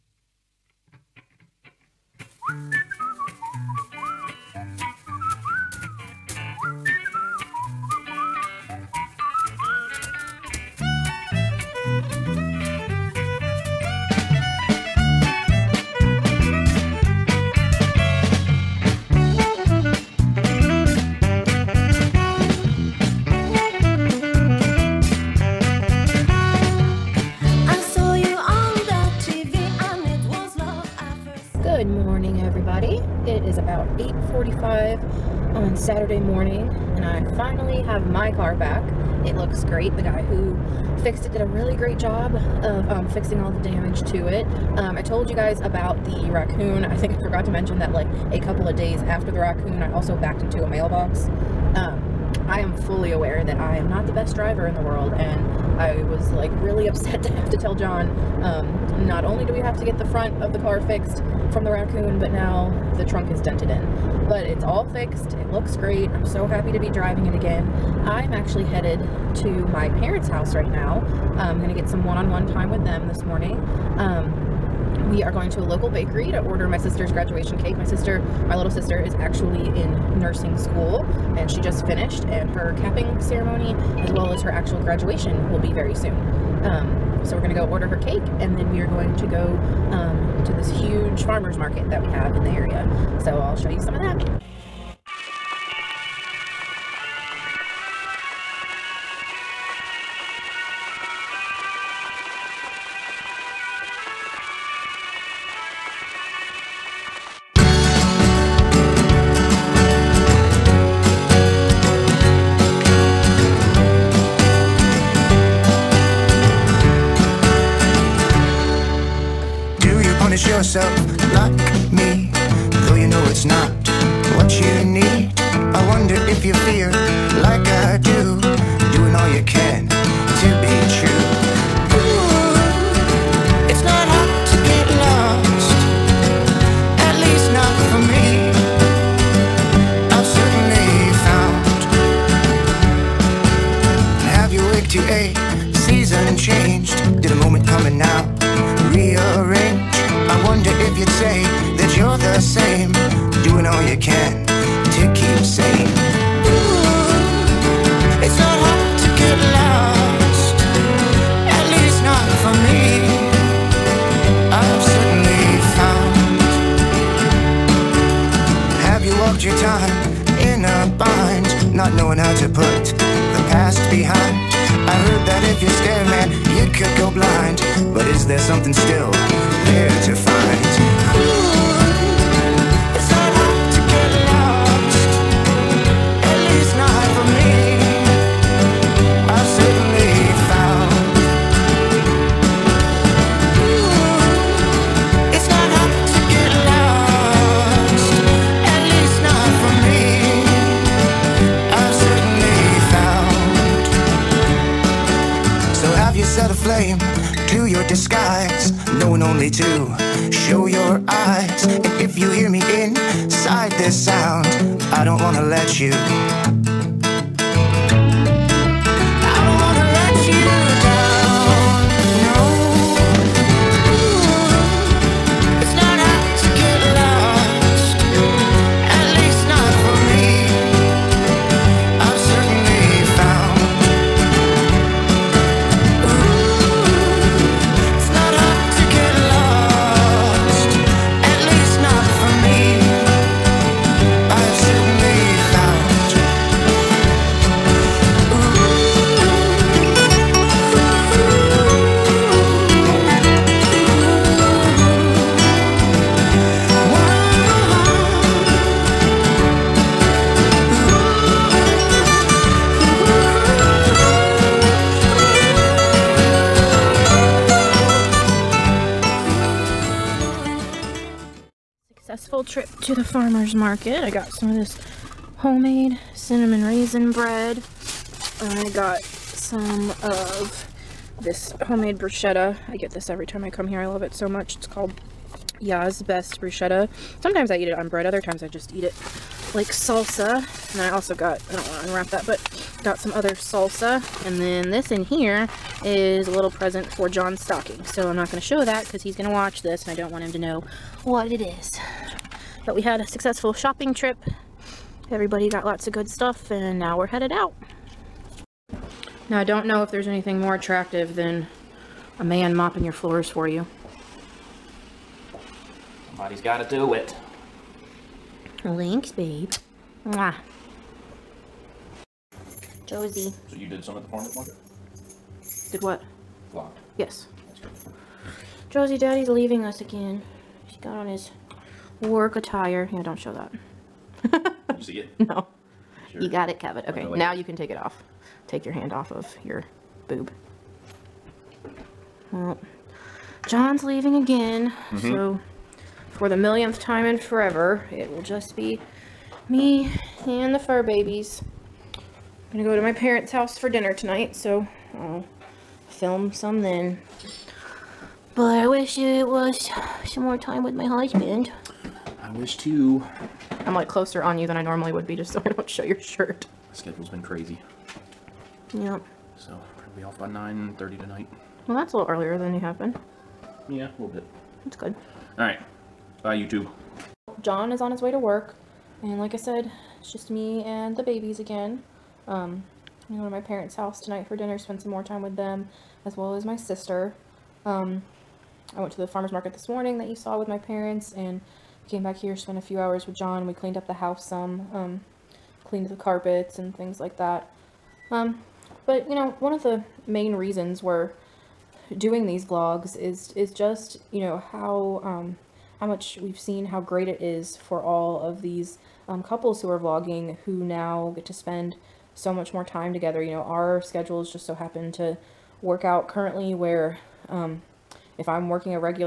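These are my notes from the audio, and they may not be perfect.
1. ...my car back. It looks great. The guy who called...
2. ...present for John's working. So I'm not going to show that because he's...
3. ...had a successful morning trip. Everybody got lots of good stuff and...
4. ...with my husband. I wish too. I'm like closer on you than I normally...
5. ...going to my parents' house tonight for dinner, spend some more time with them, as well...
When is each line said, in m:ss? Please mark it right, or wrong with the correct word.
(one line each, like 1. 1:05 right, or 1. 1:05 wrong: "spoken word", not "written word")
1. 0:38 wrong: "fixed", not "called"
2. 4:56 wrong: "stocking", not "working"
3. 5:02 wrong: "shopping", not "morning"
4. 6:00 right
5. 6:23 right.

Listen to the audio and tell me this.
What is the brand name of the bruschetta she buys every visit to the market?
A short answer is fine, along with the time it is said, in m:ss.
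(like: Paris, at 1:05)
Ya's Best Bruschetta, at 4:45.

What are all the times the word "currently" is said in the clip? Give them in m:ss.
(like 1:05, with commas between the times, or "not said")
6:56.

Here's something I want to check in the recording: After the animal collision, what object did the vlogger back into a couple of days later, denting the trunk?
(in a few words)
Mailbox.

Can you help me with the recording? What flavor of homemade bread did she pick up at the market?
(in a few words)
Cinnamon raisin.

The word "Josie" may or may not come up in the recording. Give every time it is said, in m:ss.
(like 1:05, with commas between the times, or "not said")
5:22, 5:28.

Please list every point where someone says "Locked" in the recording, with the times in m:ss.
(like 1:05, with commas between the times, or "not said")
5:26.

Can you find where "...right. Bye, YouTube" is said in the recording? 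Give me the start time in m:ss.
6:15.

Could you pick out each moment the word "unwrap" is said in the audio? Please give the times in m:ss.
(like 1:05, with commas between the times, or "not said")
4:51.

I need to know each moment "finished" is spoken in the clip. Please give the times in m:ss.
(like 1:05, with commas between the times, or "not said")
1:21.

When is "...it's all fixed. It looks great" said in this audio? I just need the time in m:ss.
1:04.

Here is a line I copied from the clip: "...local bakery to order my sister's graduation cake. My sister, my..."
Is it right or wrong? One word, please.
right.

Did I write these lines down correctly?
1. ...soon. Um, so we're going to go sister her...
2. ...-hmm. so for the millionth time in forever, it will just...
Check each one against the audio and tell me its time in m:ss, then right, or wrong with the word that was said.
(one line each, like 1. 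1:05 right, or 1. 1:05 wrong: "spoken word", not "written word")
1. 1:25 wrong: "order", not "sister"
2. 5:44 right.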